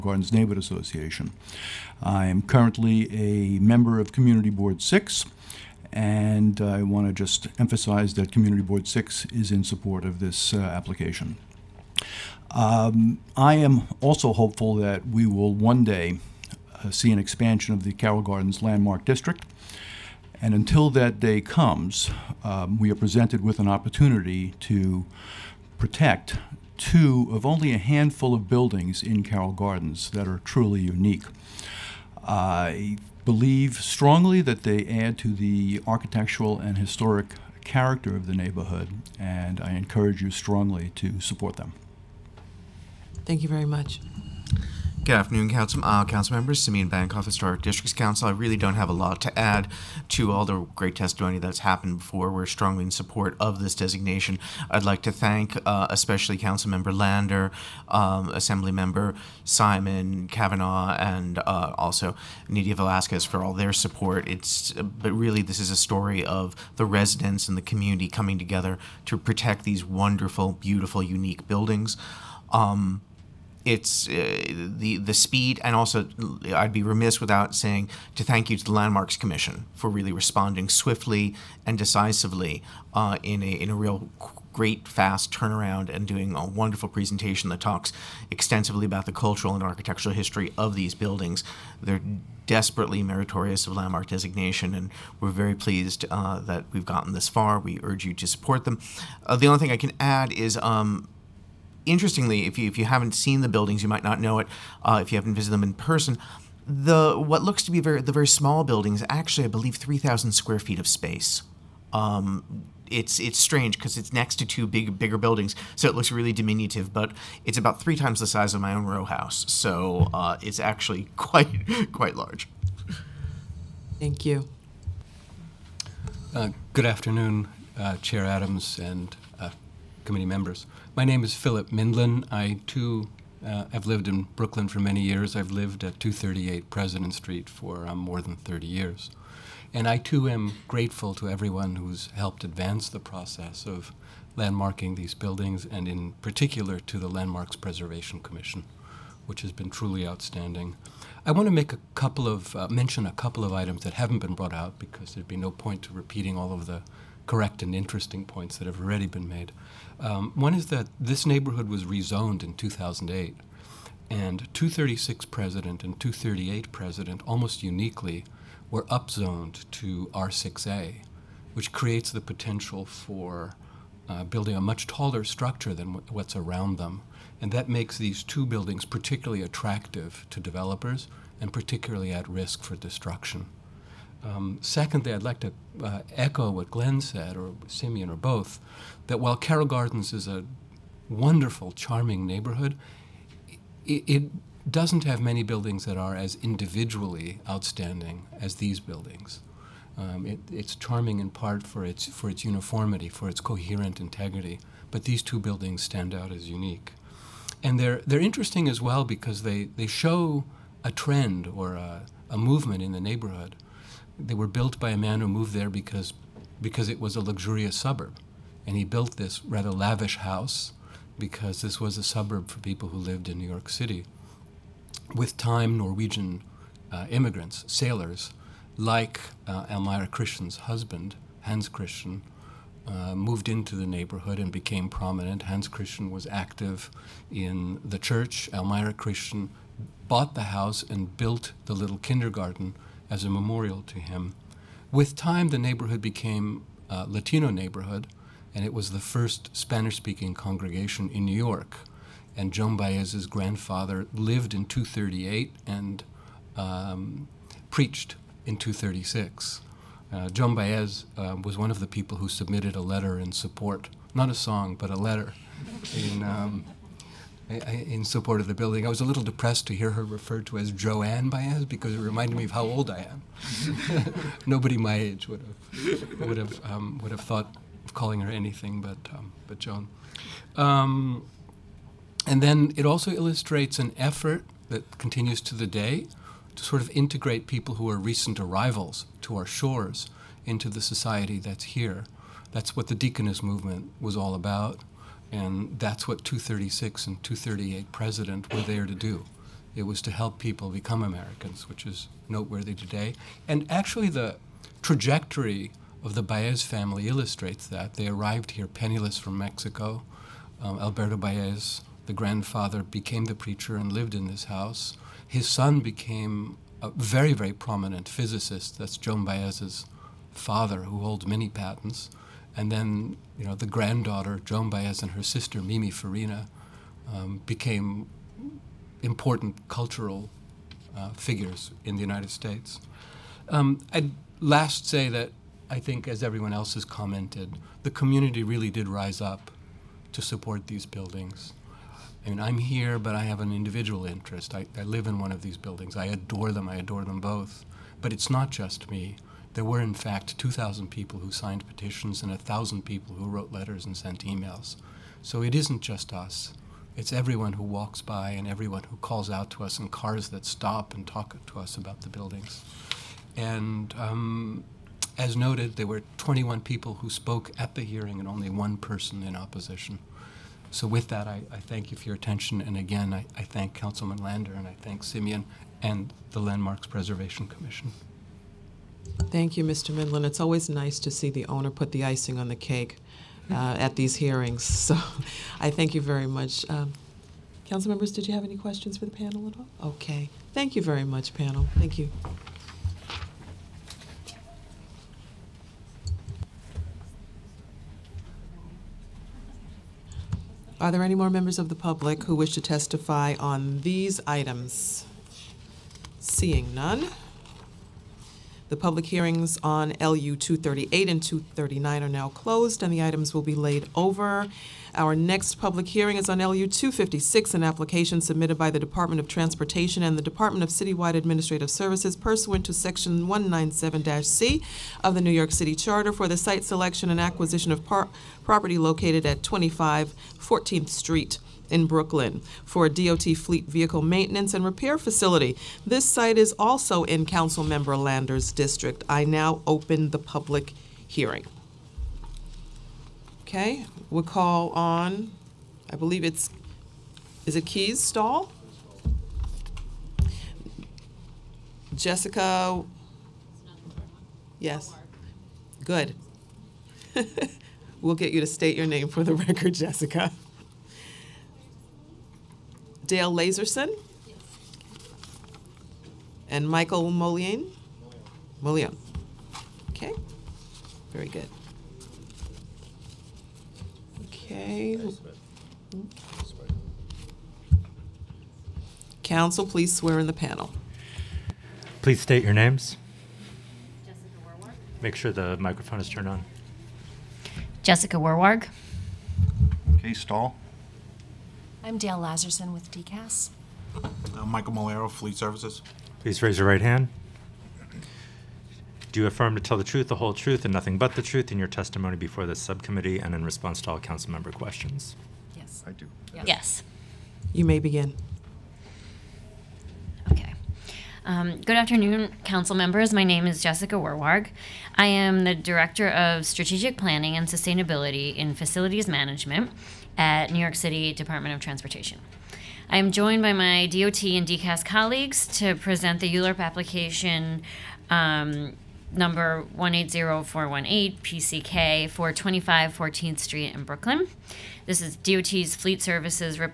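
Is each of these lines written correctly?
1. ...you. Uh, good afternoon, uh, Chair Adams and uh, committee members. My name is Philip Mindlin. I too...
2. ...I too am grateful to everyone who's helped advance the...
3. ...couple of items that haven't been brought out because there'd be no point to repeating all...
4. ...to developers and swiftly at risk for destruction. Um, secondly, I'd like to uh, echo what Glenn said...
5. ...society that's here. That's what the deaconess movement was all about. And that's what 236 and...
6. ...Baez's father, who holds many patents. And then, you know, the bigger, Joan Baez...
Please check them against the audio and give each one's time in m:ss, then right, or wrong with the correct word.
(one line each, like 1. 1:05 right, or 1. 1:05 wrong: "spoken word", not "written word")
1. 2:04 right
2. 2:19 right
3. 2:33 right
4. 3:00 wrong: "particularly", not "swiftly"
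5. 4:50 right
6. 5:19 wrong: "granddaughter", not "bigger".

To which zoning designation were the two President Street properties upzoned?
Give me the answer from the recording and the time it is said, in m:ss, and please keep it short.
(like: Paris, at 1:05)
R6A, at 2:50.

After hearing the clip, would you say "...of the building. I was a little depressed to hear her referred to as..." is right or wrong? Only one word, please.
right.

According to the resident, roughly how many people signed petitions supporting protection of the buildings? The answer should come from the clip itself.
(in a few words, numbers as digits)
2,000.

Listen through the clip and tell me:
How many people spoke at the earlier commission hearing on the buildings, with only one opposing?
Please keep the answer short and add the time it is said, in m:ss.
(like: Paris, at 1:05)
21, at 6:06.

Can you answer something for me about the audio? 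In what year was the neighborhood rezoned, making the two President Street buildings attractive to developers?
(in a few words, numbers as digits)
2008.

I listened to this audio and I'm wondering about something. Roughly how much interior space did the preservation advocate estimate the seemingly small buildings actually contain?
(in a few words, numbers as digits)
3,000 square feet.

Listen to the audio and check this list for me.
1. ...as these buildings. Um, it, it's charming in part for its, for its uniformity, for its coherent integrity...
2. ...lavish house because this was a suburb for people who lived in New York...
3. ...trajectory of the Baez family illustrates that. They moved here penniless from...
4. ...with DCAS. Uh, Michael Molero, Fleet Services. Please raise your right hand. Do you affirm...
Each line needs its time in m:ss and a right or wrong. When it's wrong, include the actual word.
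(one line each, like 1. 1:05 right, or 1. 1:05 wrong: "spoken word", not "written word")
1. 3:18 right
2. 3:39 right
3. 5:04 wrong: "arrived", not "moved"
4. 8:12 right.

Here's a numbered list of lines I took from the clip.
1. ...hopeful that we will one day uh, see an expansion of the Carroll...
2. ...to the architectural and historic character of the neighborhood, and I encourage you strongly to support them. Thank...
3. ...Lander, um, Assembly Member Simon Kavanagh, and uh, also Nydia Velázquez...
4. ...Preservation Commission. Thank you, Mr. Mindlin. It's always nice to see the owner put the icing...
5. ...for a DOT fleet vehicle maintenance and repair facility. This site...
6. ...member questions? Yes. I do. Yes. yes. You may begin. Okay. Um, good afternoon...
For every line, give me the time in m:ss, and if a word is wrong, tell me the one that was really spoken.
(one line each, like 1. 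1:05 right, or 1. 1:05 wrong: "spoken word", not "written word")
1. 0:14 right
2. 0:35 right
3. 0:56 right
4. 6:16 right
5. 7:12 right
6. 8:24 right.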